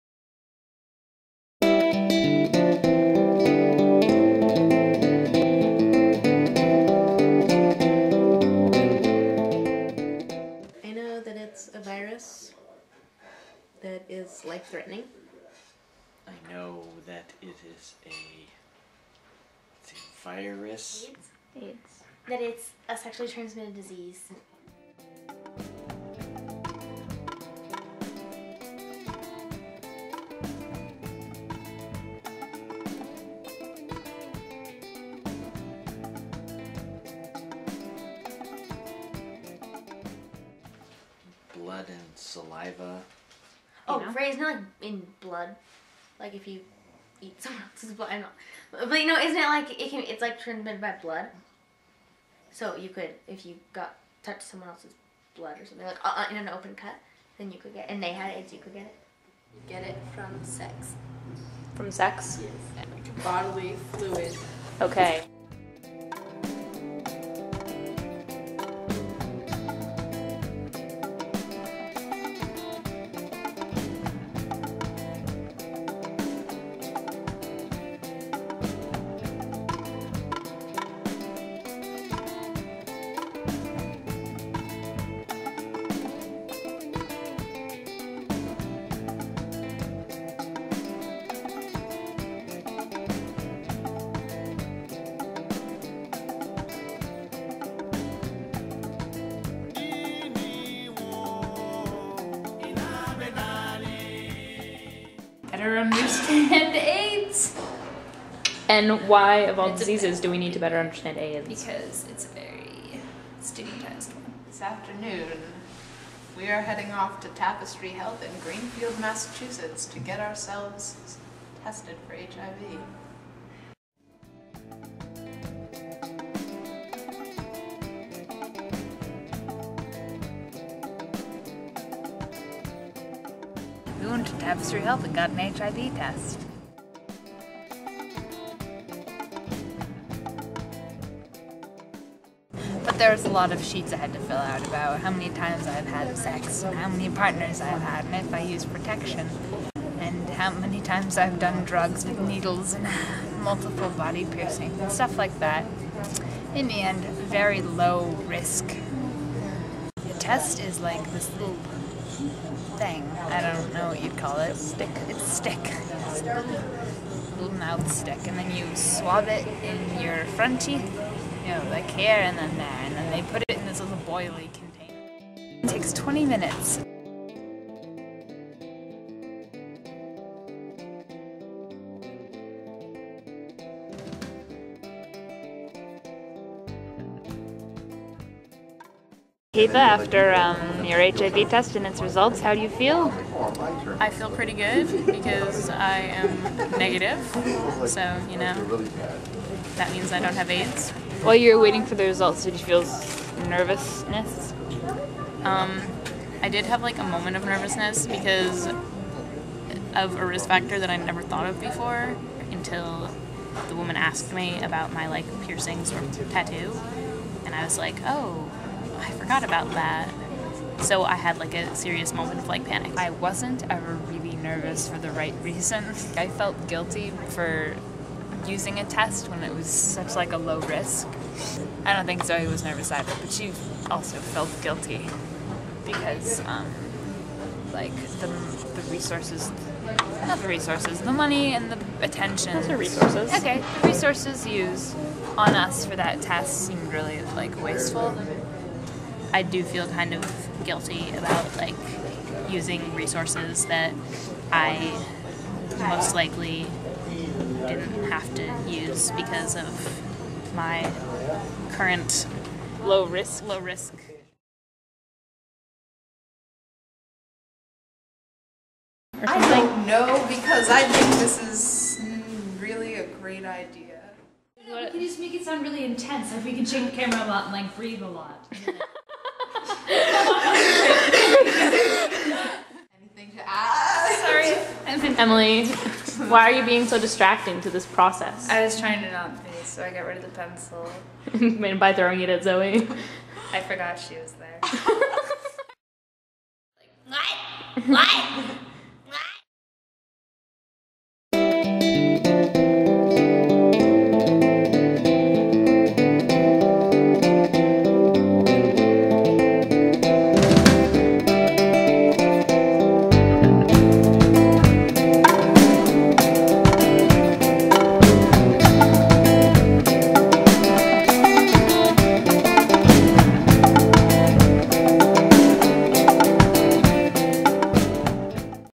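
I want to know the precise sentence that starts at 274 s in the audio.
Know, we can just make it sound really intense.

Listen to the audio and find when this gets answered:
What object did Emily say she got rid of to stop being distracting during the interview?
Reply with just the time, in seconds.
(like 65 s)
290 s.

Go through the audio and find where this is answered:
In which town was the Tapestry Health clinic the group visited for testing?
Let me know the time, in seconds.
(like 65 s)
118 s.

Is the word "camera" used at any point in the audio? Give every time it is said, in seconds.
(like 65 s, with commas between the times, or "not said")
276 s.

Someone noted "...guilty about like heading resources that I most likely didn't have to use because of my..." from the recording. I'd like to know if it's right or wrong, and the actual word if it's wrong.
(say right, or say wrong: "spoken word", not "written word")
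wrong: "using", not "heading".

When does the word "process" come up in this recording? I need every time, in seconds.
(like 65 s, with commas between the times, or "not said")
287 s.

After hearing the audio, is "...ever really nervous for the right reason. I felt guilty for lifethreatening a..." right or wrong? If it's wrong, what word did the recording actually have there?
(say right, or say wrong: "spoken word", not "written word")
wrong: "using", not "lifethreatening".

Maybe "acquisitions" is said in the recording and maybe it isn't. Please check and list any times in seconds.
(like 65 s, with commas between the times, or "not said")
not said.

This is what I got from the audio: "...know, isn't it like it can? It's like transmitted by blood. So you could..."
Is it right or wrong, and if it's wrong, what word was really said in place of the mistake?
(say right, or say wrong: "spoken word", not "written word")
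right.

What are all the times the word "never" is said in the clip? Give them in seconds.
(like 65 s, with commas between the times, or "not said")
210 s.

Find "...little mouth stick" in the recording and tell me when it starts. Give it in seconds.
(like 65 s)
166 s.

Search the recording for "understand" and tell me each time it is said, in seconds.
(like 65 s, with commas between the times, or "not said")
105 s, 110 s.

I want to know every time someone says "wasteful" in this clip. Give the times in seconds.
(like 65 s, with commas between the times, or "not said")
247 s.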